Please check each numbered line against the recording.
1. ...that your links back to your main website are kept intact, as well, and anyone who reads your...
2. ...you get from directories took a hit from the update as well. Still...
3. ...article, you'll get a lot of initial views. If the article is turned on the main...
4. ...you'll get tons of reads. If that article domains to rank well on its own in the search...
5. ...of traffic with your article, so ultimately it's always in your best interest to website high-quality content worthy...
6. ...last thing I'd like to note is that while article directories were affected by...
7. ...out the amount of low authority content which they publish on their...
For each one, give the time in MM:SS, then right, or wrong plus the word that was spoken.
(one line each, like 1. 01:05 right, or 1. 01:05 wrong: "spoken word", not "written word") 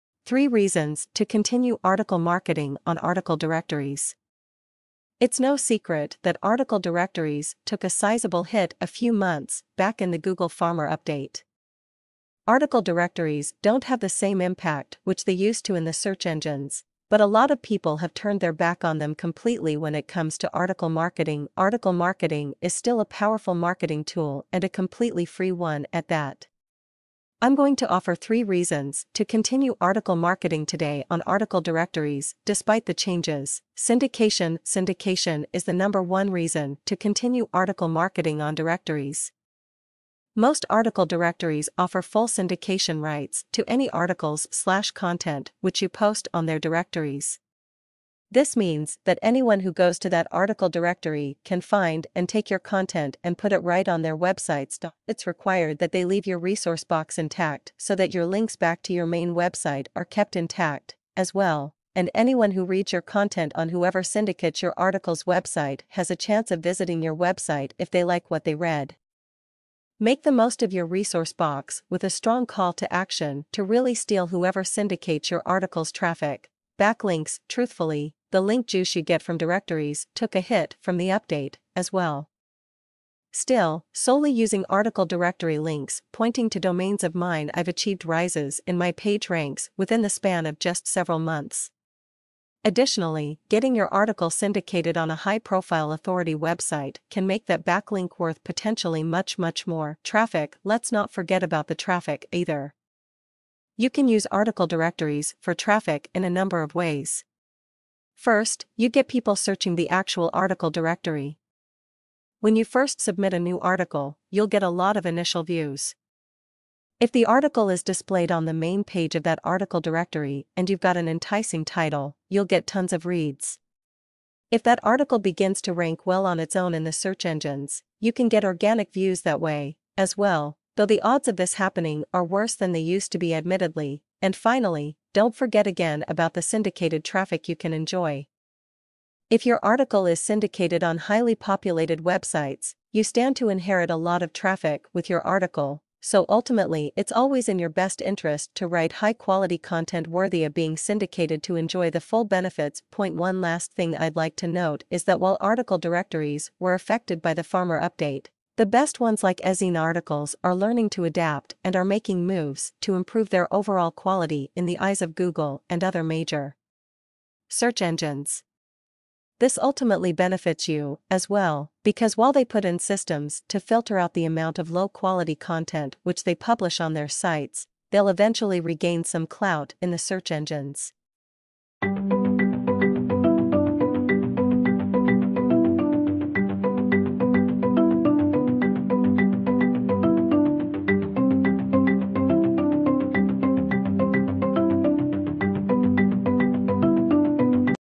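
1. 00:57 right
2. 01:18 right
3. 01:53 wrong: "displayed", not "turned"
4. 02:02 wrong: "begins", not "domains"
5. 02:24 wrong: "write", not "website"
6. 02:33 right
7. 02:53 wrong: "quality", not "authority".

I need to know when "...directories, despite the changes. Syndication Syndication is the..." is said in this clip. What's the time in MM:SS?
00:31.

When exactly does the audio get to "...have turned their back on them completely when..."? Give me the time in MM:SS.
00:17.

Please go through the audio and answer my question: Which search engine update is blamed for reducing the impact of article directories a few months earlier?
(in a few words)
Google Farmer update.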